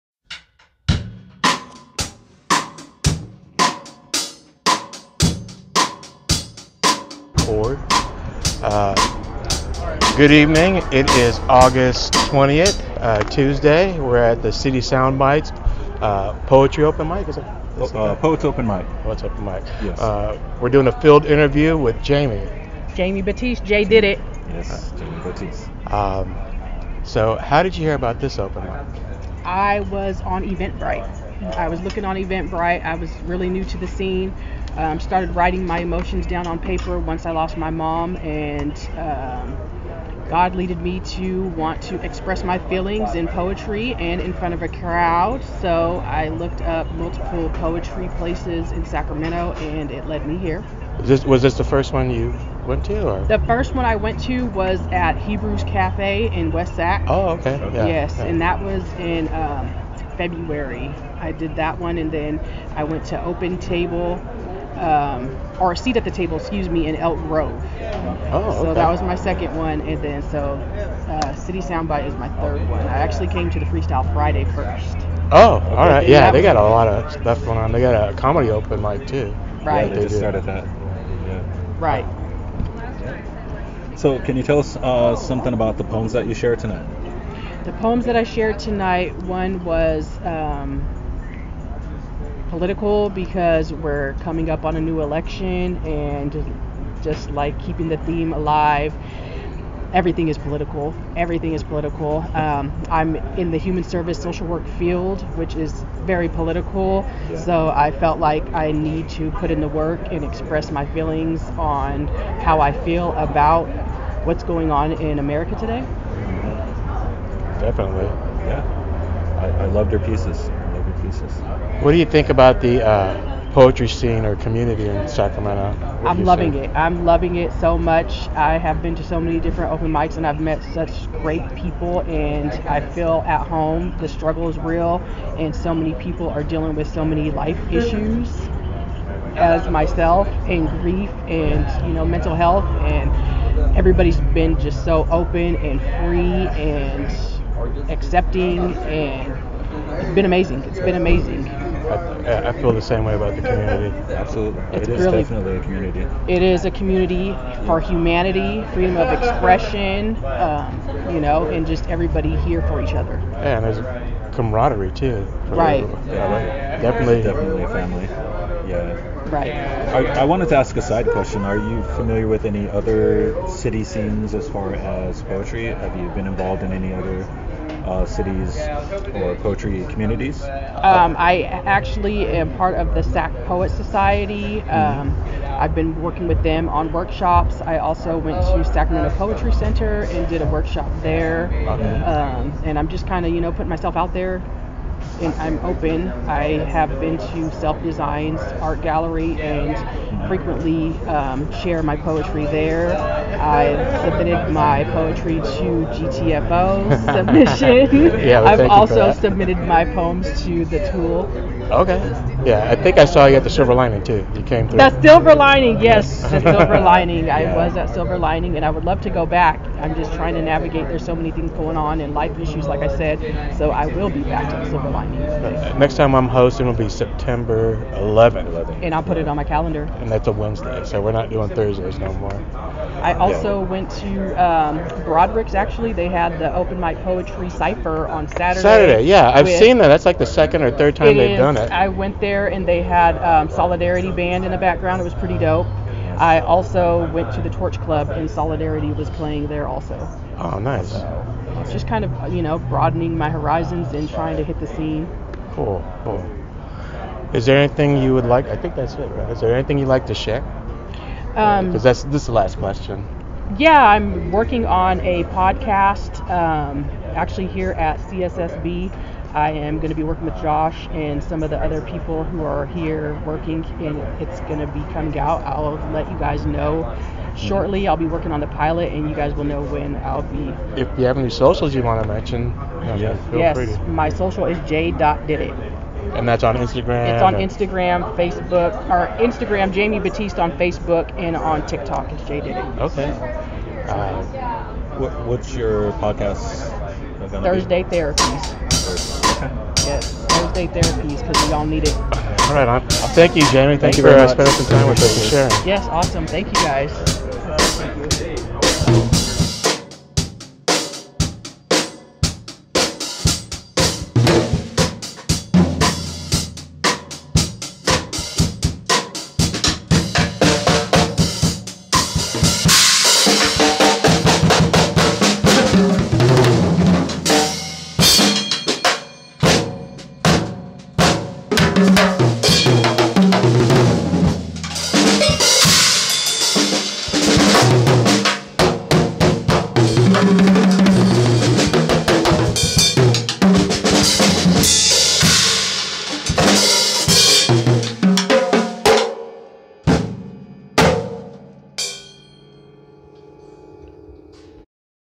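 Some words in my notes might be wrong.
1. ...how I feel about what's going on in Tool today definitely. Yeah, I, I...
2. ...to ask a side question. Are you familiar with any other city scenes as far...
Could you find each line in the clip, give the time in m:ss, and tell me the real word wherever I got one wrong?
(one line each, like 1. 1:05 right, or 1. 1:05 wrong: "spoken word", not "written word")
1. 1:52 wrong: "America", not "Tool"
2. 2:50 right.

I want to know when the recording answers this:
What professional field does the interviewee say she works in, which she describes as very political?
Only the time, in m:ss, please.
1:43.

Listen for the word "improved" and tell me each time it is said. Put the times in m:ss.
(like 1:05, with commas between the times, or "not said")
not said.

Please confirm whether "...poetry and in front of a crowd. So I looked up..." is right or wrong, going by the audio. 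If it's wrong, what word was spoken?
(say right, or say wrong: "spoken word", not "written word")
right.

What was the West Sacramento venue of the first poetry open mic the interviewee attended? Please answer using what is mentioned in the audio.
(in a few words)
Hebrews Cafe.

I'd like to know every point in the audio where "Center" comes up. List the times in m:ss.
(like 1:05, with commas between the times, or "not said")
3:09.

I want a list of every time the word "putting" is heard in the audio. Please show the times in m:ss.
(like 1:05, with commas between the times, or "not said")
3:13.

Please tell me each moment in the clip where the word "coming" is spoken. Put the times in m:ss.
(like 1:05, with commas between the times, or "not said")
1:34, 4:34.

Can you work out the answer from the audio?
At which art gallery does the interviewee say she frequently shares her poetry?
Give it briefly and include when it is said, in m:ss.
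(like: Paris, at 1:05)
Self Designs Art Gallery, at 3:17.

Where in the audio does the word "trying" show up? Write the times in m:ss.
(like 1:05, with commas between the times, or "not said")
3:40, 4:14.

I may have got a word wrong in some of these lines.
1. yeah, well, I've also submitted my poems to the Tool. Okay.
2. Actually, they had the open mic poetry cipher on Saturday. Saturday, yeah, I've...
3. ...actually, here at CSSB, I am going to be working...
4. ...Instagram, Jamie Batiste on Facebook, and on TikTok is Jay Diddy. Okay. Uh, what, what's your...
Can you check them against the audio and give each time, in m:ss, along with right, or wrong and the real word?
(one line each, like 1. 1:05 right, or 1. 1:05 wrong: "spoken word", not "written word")
1. 3:28 right
2. 3:55 right
3. 4:27 right
4. 4:49 right.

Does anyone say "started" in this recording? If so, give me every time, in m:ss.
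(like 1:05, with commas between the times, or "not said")
0:34, 1:20.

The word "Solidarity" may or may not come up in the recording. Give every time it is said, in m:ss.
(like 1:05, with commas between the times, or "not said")
4:03, 4:08.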